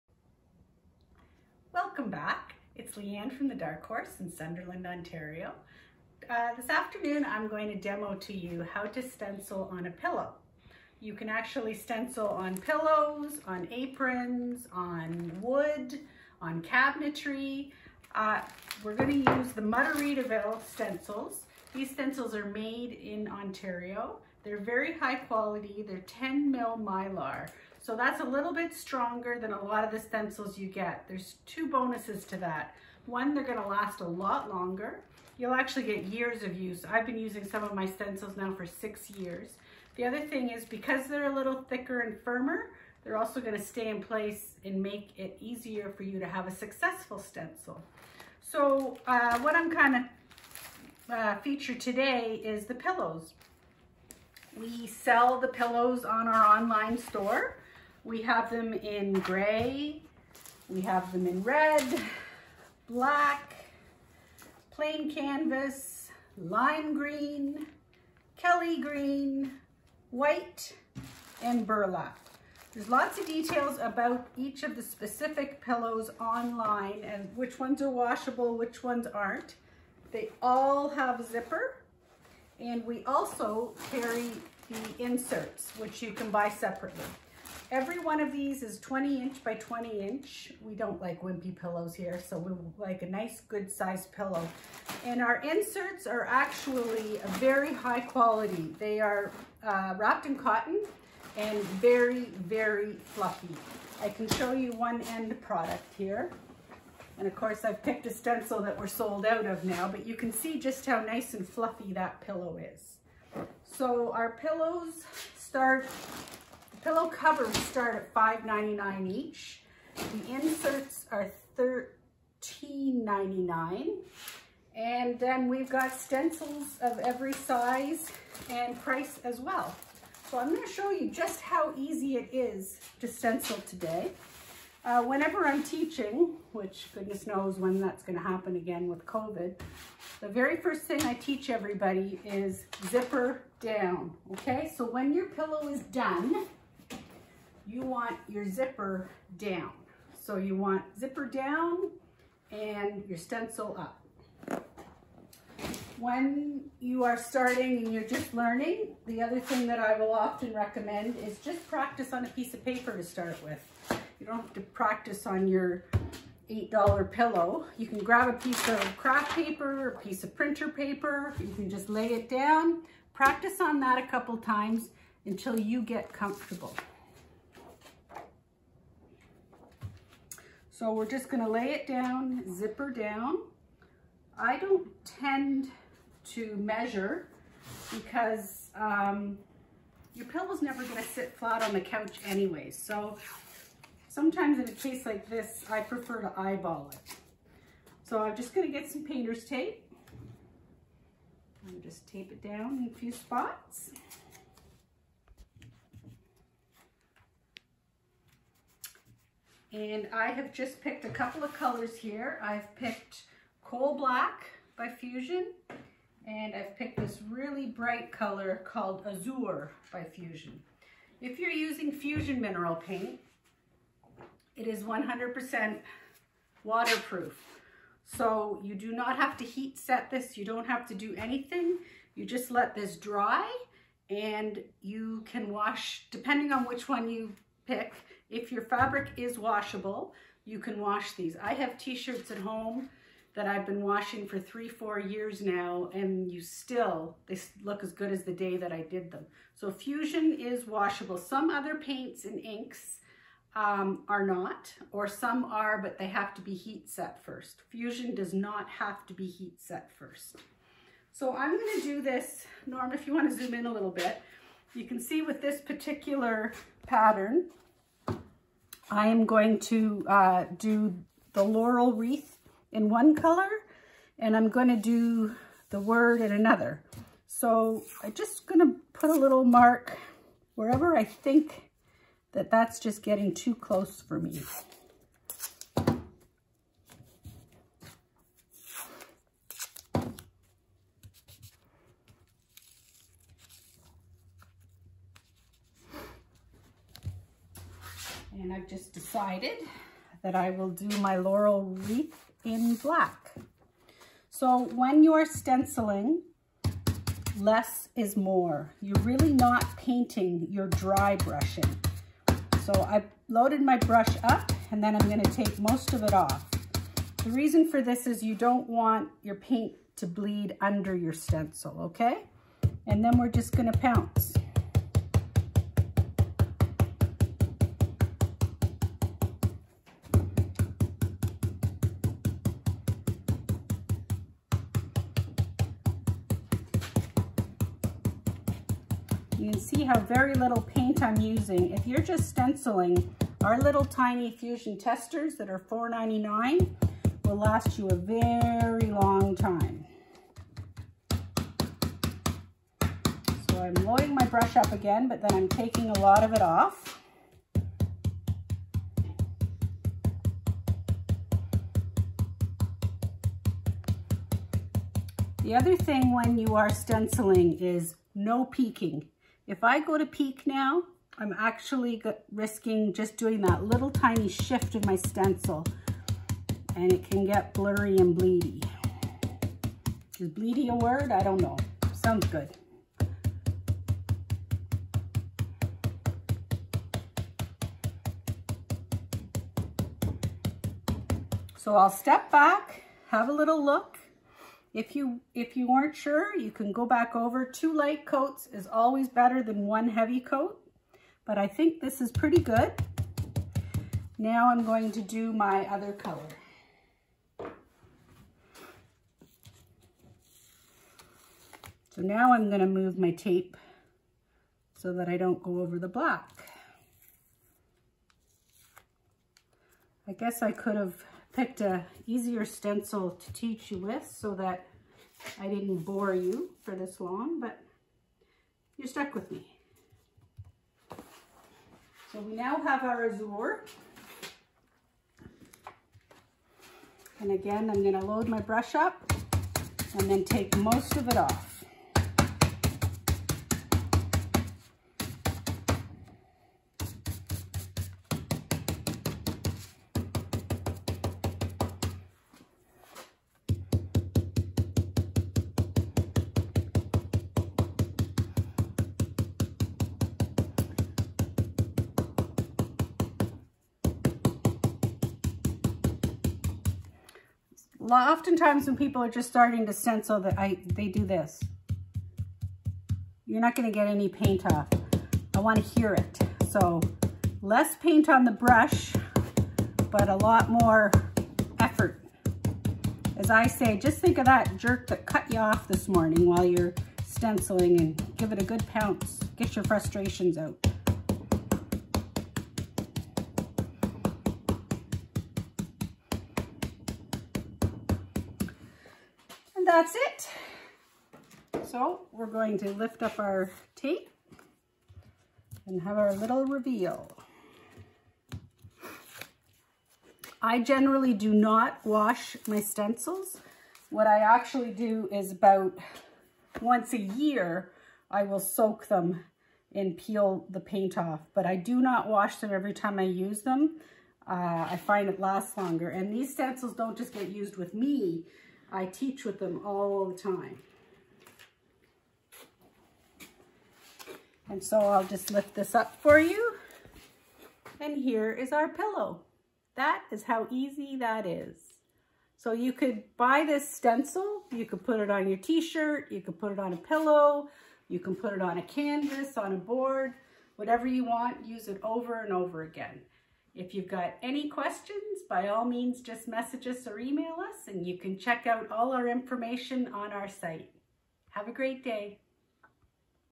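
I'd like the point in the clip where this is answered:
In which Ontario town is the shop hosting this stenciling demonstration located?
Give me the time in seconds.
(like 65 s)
4 s.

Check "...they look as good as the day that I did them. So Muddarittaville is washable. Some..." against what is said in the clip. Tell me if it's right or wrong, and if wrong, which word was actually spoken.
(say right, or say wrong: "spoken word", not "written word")
wrong: "Fusion", not "Muddarittaville".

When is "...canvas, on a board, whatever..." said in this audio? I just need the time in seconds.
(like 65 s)
548 s.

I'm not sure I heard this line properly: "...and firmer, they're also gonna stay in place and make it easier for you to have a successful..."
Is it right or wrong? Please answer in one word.
right.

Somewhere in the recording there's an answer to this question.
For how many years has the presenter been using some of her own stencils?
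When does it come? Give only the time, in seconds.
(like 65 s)
38 s.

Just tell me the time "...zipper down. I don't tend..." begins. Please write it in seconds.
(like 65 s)
182 s.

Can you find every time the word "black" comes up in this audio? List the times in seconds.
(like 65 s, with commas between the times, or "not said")
62 s, 213 s, 302 s, 415 s.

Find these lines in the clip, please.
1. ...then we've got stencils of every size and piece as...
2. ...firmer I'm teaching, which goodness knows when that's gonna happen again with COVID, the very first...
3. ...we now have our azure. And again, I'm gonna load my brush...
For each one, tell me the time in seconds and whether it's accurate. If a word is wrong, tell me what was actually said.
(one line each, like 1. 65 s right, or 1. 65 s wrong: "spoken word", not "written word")
1. 125 s wrong: "price", not "piece"
2. 135 s wrong: "whenever", not "firmer"
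3. 432 s right.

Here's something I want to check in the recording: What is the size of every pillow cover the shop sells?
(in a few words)
20 inch by 20 inch.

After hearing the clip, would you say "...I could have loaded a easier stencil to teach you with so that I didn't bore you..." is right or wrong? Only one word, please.
wrong.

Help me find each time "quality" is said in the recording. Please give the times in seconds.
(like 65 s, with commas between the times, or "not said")
25 s, 98 s.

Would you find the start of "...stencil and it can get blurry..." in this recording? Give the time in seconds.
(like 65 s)
374 s.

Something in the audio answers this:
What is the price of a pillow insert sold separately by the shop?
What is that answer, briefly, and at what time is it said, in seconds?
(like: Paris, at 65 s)
$13.99, at 121 s.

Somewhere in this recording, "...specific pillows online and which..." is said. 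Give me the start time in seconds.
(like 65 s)
74 s.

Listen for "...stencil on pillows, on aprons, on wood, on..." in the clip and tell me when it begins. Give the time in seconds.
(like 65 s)
11 s.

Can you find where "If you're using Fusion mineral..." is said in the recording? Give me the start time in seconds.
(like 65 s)
221 s.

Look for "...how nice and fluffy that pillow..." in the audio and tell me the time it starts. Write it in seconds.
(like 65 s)
110 s.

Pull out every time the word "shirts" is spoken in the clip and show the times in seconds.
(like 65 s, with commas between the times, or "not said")
241 s, 545 s.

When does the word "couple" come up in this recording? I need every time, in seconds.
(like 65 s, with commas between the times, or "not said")
174 s, 211 s.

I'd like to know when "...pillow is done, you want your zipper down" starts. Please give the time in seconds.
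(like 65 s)
145 s.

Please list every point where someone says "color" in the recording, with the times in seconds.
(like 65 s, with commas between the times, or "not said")
211 s, 218 s, 273 s, 405 s.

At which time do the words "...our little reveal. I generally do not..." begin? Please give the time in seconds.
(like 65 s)
505 s.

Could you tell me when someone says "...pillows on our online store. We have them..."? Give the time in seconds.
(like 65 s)
55 s.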